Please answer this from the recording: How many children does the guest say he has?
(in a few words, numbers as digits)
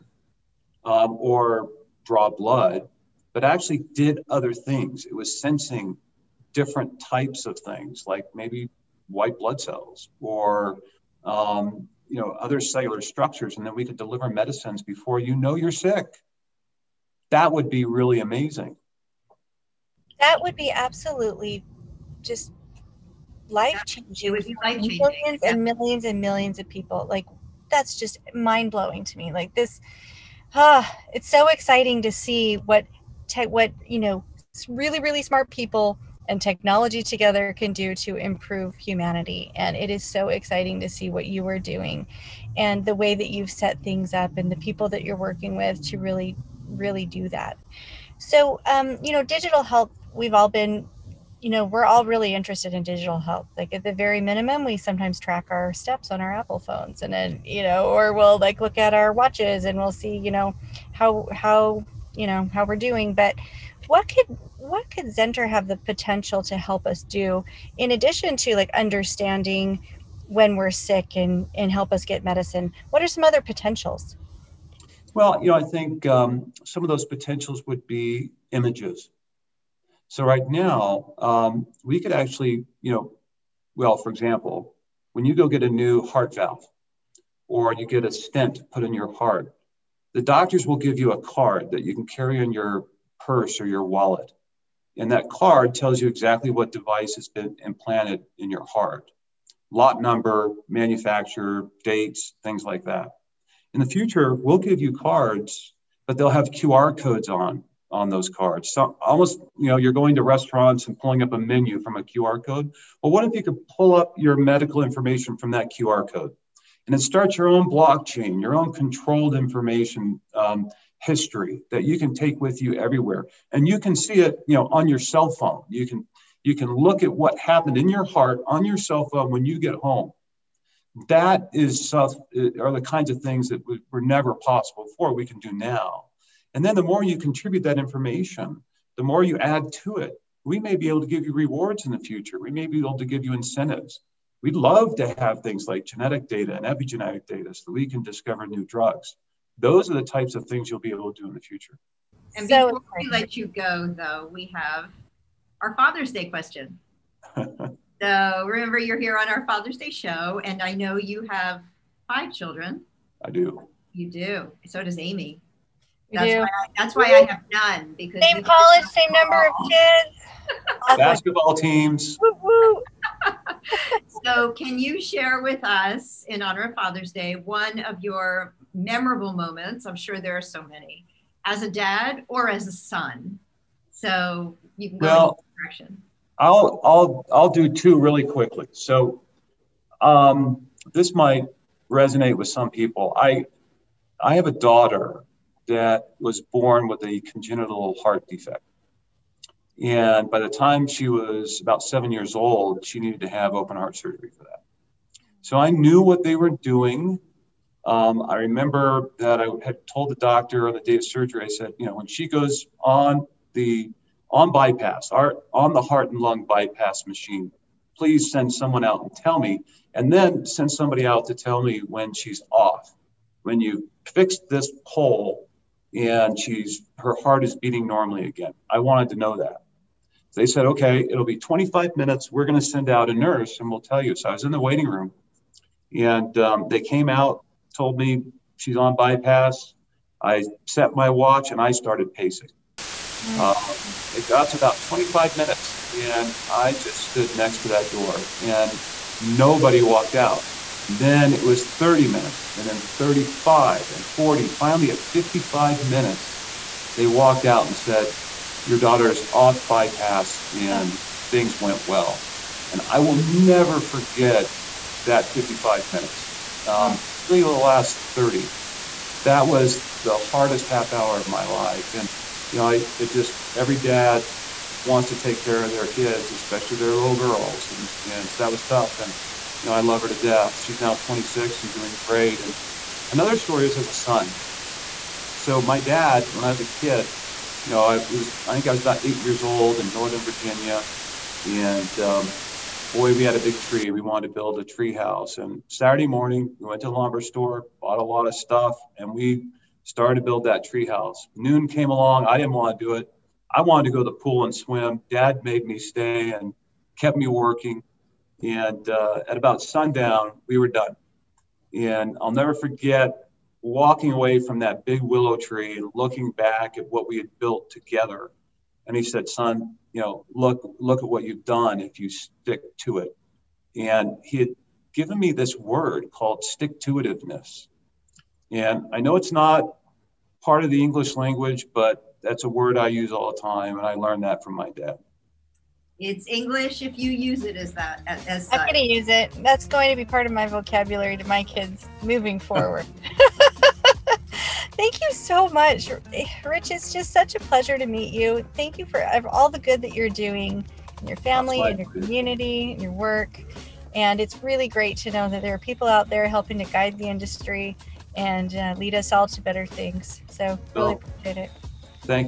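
5.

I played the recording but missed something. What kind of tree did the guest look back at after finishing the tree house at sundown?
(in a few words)
willow.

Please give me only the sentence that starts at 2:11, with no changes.
That is stuff uh, are the kinds of things that were never possible before we can do now.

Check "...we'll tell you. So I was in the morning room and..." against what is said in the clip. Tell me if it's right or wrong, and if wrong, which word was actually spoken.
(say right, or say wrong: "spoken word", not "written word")
wrong: "waiting", not "morning".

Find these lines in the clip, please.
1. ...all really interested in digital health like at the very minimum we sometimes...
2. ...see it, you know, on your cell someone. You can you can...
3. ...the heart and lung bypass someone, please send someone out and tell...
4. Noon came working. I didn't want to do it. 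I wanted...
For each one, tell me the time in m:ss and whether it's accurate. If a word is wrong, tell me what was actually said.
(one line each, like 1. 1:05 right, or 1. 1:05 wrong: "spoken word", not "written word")
1. 0:51 right
2. 2:03 wrong: "phone", not "someone"
3. 3:35 wrong: "machine", not "someone"
4. 5:01 wrong: "along", not "working".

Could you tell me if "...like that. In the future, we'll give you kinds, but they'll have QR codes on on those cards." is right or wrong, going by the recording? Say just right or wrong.
wrong.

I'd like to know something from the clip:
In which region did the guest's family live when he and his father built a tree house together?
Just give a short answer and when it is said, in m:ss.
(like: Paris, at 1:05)
Northern Virginia, at 4:49.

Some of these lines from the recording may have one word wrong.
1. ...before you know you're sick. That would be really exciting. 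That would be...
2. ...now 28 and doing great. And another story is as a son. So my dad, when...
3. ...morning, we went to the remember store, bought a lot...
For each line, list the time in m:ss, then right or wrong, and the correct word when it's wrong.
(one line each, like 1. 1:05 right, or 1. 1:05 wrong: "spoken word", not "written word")
1. 0:14 wrong: "amazing", not "exciting"
2. 4:40 wrong: "26", not "28"
3. 4:56 wrong: "lumber", not "remember".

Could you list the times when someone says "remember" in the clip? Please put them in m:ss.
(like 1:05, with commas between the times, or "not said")
2:38, 3:28.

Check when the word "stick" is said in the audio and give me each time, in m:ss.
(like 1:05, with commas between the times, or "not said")
5:22, 5:26.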